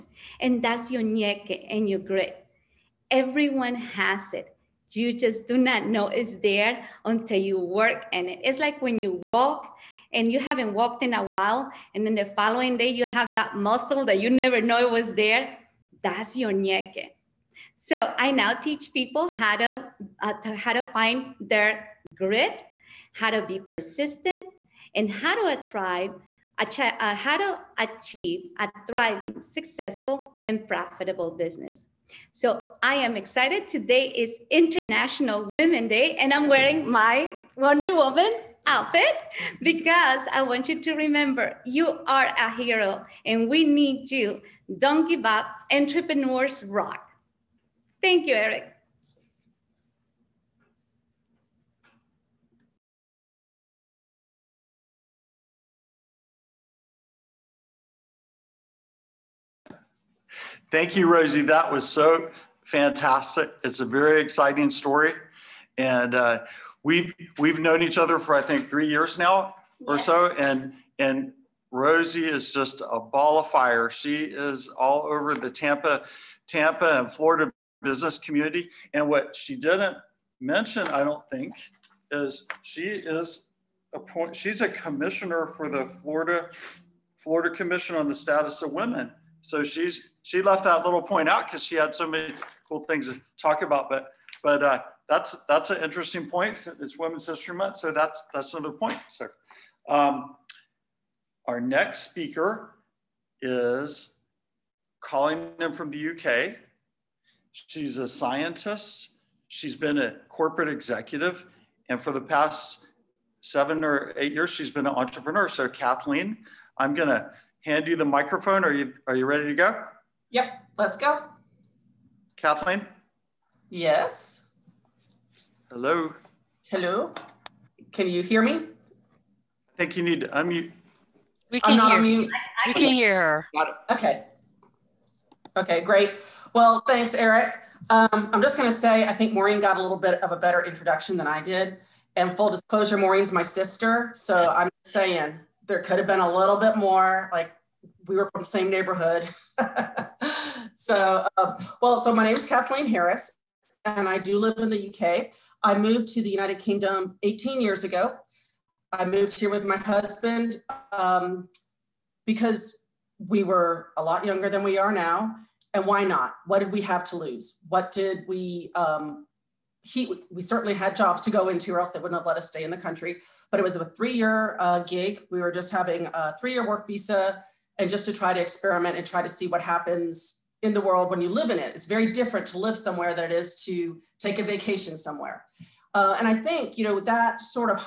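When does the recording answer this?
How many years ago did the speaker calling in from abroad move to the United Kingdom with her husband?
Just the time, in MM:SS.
02:37.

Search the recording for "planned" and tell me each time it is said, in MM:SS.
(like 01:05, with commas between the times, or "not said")
not said.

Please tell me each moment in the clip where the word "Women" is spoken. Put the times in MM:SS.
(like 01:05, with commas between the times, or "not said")
00:35, 01:28, 01:36.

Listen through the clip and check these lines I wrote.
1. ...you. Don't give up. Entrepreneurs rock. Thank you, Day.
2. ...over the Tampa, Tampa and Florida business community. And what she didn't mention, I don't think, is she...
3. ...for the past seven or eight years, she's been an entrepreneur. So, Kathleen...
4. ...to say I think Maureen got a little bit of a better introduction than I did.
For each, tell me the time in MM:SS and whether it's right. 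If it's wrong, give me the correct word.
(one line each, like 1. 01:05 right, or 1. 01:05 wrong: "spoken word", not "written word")
1. 00:44 wrong: "Eric", not "Day"
2. 01:15 right
3. 01:51 right
4. 02:18 right.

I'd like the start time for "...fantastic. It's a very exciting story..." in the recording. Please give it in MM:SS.
01:02.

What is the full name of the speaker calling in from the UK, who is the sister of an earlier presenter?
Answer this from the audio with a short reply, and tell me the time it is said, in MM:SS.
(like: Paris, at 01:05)
Kathleen Harris, at 02:32.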